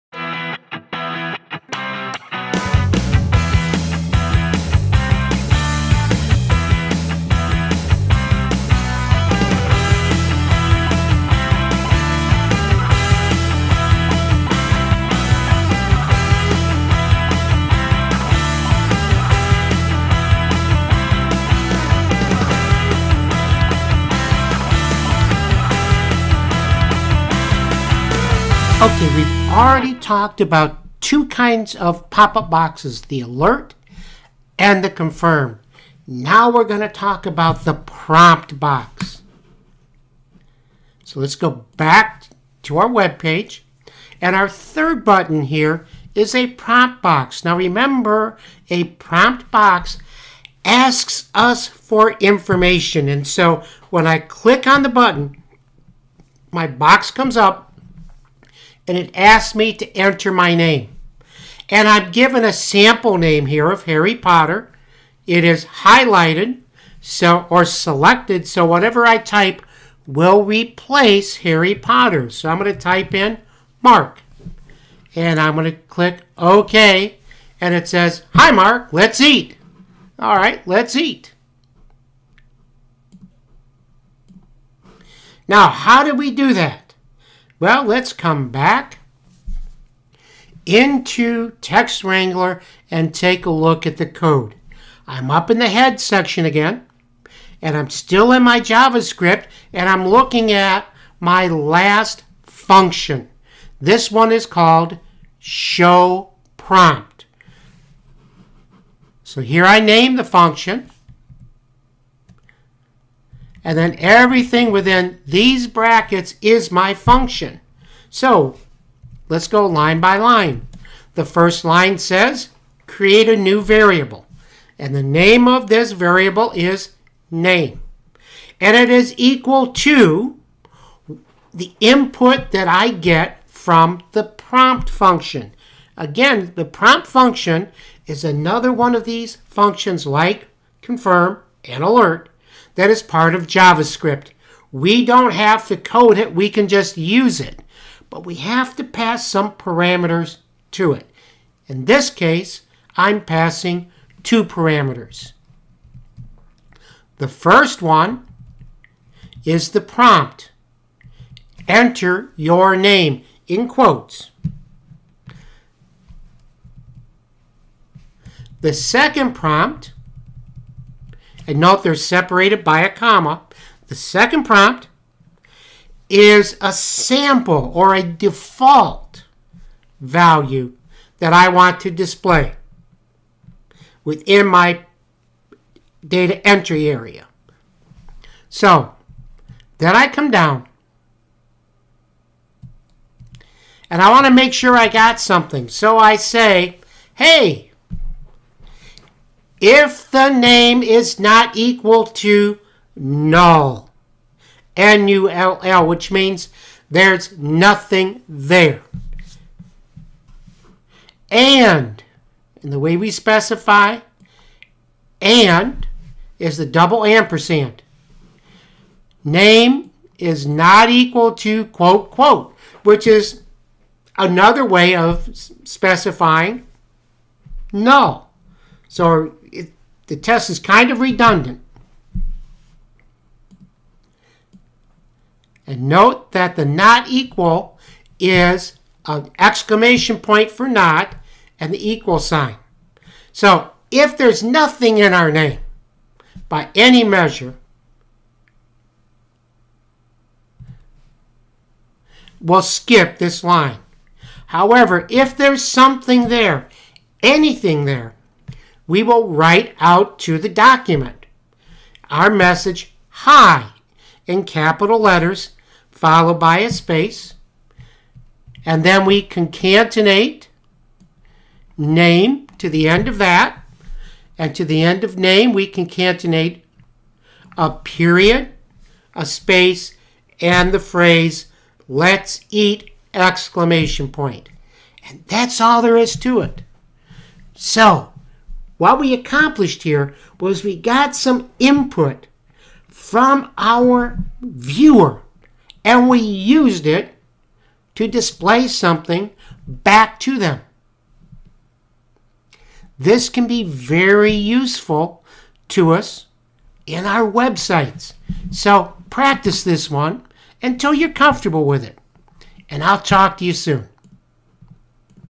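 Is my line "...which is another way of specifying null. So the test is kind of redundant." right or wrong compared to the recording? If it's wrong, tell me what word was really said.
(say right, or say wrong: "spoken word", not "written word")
right.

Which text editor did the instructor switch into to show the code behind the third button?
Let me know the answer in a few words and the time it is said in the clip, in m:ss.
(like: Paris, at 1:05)
Text Wrangler, at 1:31.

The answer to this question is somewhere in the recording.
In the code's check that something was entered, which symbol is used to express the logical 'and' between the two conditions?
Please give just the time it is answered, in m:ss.
3:36.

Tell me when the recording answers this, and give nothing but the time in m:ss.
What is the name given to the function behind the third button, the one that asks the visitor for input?
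1:45.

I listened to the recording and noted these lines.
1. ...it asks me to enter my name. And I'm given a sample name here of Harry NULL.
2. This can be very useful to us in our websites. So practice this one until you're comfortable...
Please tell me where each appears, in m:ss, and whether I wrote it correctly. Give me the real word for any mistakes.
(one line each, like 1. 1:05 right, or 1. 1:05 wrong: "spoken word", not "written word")
1. 0:58 wrong: "Potter", not "NULL"
2. 5:02 right.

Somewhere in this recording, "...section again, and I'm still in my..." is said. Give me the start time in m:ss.
1:35.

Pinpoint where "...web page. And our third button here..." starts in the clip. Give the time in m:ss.
0:42.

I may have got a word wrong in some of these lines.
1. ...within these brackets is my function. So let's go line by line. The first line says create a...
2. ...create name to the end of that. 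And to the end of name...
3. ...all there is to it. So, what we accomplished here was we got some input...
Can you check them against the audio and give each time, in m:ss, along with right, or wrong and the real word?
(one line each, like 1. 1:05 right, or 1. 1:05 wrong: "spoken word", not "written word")
1. 1:54 right
2. 4:29 wrong: "concatenate", not "create"
3. 4:45 right.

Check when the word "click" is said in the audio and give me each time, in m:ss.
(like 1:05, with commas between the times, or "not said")
0:54, 1:15.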